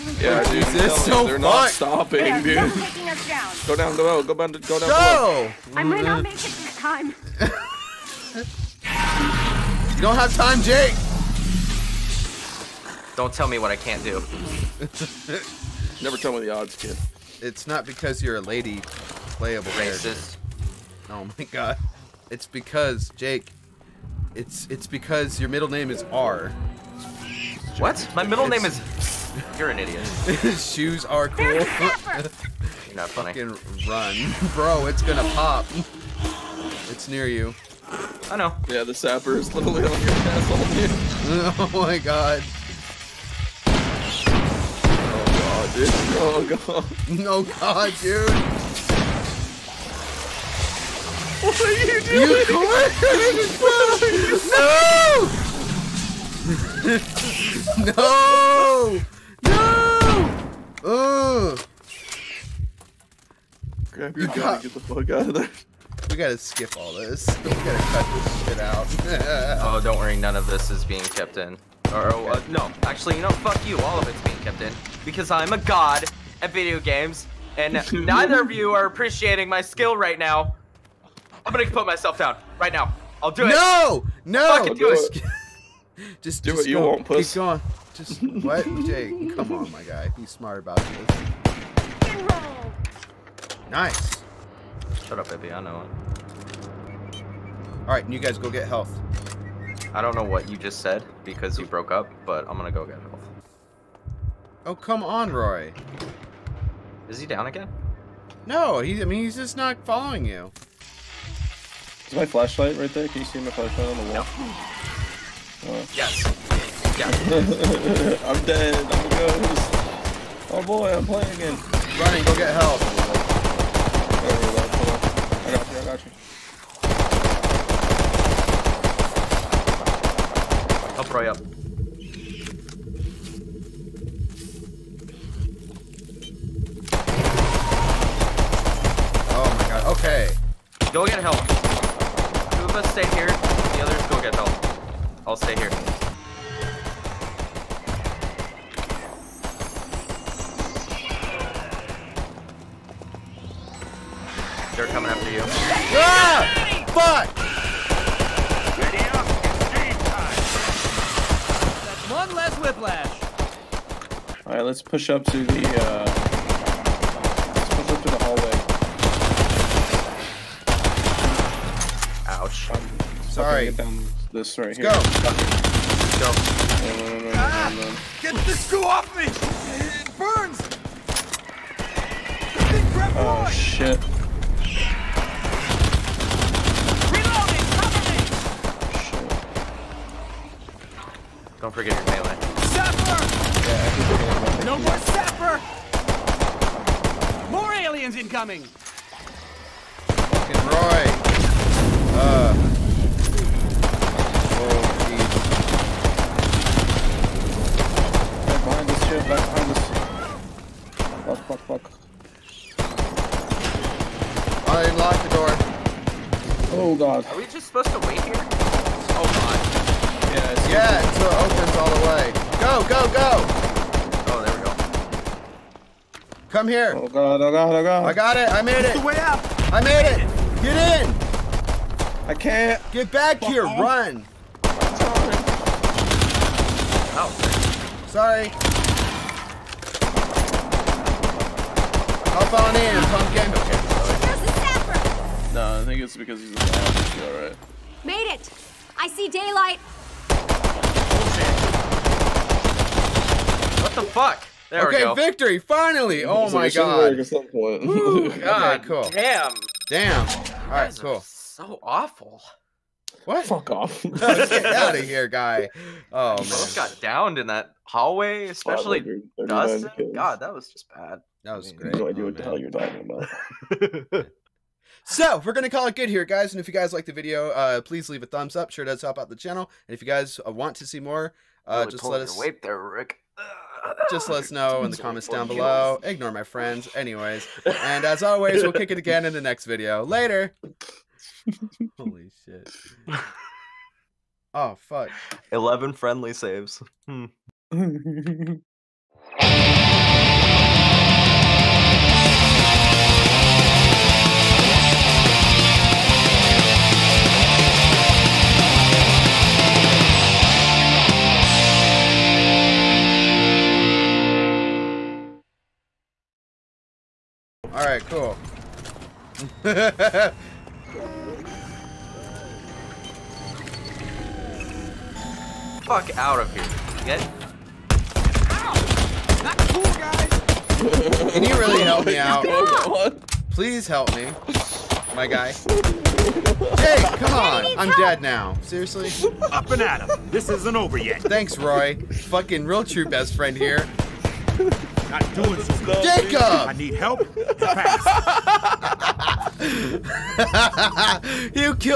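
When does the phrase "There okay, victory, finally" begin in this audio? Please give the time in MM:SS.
04:14.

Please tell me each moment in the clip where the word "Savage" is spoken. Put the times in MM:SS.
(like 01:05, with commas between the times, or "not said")
not said.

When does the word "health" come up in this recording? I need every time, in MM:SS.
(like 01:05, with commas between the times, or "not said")
01:38, 01:42.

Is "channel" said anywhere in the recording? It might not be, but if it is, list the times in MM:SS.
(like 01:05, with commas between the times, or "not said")
04:39.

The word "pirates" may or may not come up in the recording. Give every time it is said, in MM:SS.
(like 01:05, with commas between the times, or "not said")
not said.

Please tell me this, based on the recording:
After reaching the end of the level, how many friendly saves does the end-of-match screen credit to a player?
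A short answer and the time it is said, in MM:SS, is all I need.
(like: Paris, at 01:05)
11, at 04:55.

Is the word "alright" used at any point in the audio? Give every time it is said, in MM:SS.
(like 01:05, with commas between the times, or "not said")
02:44, 04:07, 04:20, 05:17.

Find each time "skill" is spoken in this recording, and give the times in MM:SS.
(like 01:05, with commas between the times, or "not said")
01:19.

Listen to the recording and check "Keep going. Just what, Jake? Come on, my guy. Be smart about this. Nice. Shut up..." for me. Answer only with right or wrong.
right.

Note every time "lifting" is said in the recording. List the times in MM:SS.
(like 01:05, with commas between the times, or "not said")
not said.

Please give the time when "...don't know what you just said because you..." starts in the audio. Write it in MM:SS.
01:40.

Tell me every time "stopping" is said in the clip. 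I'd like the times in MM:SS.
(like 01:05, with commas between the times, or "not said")
00:01.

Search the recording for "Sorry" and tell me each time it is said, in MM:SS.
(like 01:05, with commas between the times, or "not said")
03:58.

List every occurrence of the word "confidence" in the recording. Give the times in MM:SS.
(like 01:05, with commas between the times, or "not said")
not said.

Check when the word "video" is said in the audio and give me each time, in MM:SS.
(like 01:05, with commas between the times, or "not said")
01:16, 04:37, 04:49.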